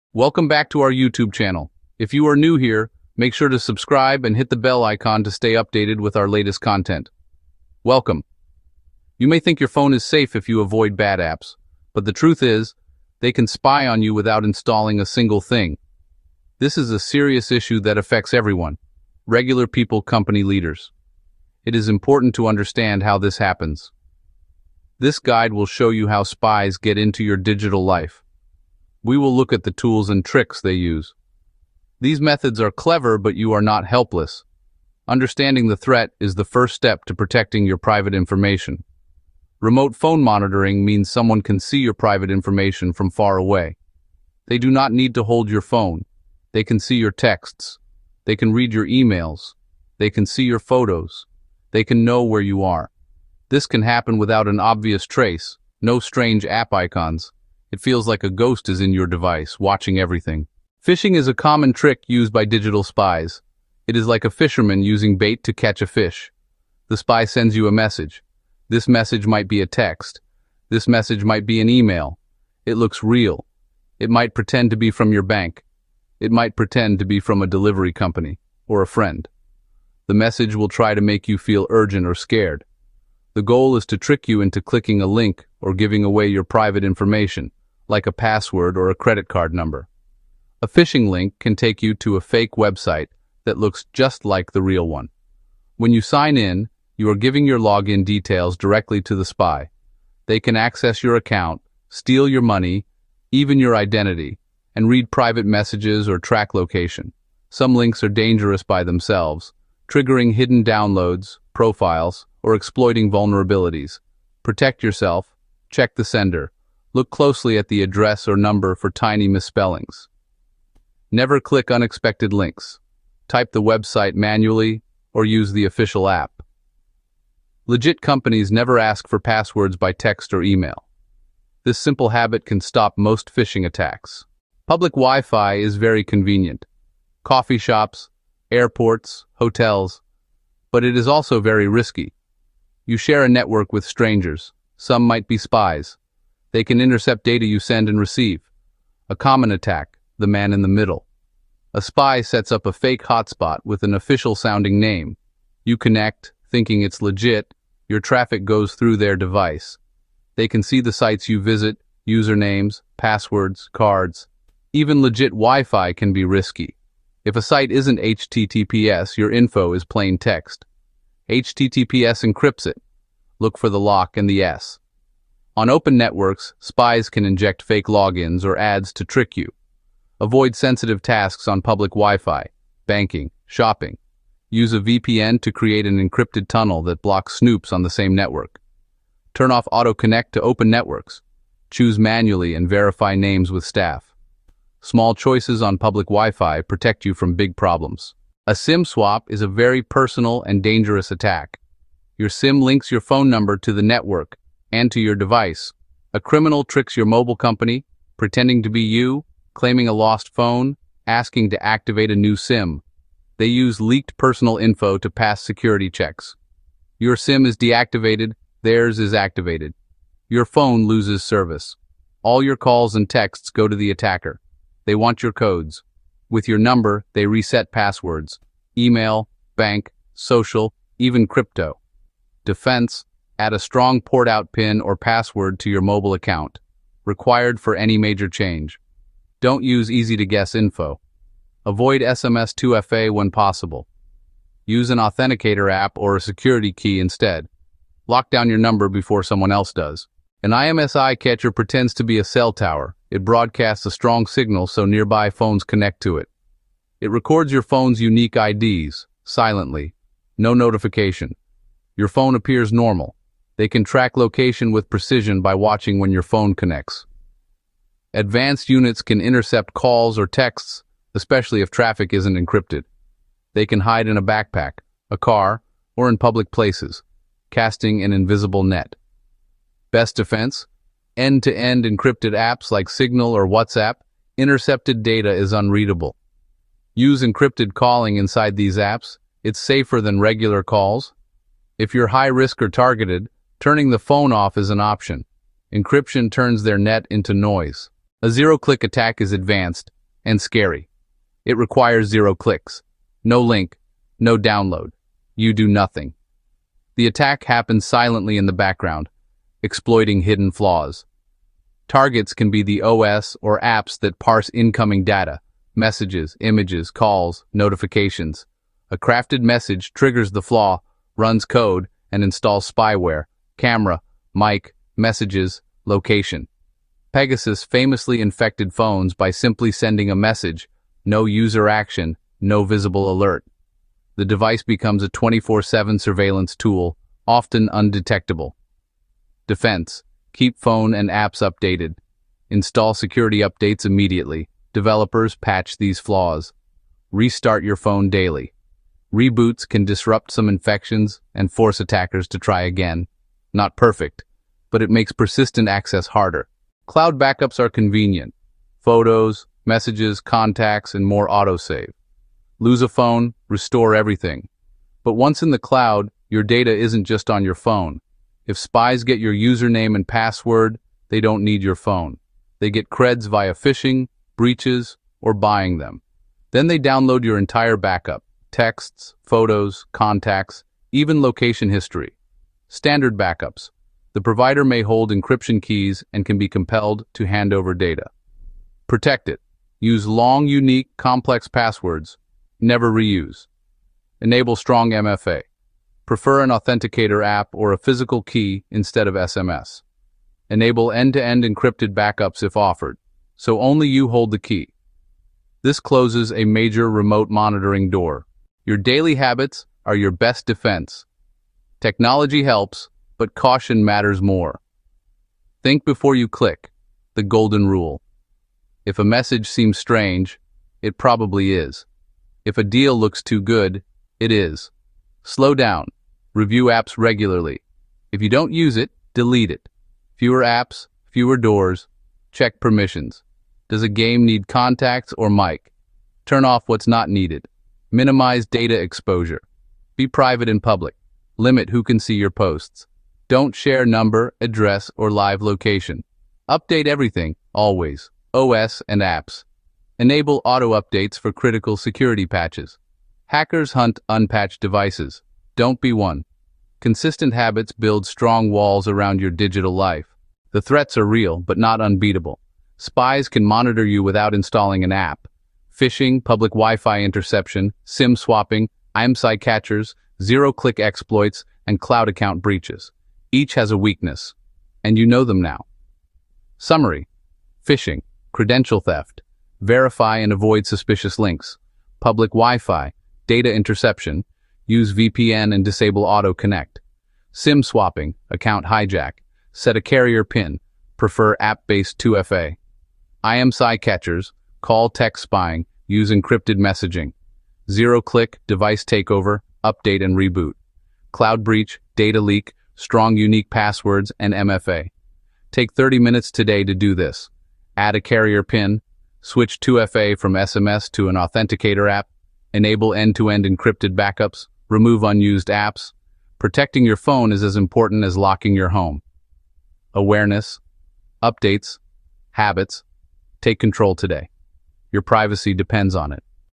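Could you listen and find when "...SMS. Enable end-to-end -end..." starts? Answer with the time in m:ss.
6:39.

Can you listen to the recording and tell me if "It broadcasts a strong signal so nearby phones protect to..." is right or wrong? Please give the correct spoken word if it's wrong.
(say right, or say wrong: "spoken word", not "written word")
wrong: "connect", not "protect".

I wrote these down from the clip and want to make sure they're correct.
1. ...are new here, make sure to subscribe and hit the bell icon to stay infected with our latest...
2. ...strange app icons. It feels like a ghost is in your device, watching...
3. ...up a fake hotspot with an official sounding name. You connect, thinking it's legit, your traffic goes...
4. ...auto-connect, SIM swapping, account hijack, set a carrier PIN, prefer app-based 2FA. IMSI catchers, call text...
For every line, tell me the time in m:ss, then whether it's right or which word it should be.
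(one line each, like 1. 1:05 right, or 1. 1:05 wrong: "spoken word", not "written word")
1. 0:02 wrong: "updated", not "infected"
2. 0:55 right
3. 2:32 right
4. 8:06 right.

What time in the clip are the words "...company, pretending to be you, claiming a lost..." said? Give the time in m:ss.
3:27.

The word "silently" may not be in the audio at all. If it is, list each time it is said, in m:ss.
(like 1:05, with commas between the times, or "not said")
4:19, 5:07.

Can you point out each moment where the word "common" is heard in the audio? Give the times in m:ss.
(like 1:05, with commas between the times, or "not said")
1:01, 2:29.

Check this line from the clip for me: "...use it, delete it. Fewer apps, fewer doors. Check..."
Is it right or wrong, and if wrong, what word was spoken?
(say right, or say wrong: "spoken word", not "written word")
right.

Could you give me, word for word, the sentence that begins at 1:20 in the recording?
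The message will try to make you feel urgent or scared.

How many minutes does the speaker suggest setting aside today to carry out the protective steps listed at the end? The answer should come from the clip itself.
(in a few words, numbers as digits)
30.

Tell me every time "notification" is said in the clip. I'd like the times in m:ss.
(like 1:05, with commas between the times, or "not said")
4:20, 5:17.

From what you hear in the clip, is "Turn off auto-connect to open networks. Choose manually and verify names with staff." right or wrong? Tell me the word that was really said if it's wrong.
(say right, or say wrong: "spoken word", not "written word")
right.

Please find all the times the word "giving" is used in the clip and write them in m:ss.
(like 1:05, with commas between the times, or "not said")
1:25, 1:37.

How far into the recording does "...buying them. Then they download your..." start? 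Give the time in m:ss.
6:15.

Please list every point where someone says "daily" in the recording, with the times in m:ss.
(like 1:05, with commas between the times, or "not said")
5:48, 6:48.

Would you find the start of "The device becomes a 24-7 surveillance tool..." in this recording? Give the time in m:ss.
5:34.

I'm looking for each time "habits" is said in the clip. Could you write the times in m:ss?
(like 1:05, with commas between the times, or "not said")
2:12, 6:49, 7:37, 8:42.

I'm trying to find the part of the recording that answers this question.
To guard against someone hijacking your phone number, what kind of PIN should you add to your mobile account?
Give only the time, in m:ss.
3:54.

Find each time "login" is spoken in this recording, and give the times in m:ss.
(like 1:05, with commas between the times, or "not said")
1:37, 2:57.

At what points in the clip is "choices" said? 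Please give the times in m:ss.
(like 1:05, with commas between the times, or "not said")
3:15.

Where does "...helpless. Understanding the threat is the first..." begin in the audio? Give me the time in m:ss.
0:33.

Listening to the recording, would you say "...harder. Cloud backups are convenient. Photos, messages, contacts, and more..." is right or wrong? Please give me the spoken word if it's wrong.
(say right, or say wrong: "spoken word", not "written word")
right.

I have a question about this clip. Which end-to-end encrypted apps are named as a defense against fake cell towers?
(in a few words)
Signal or WhatsApp.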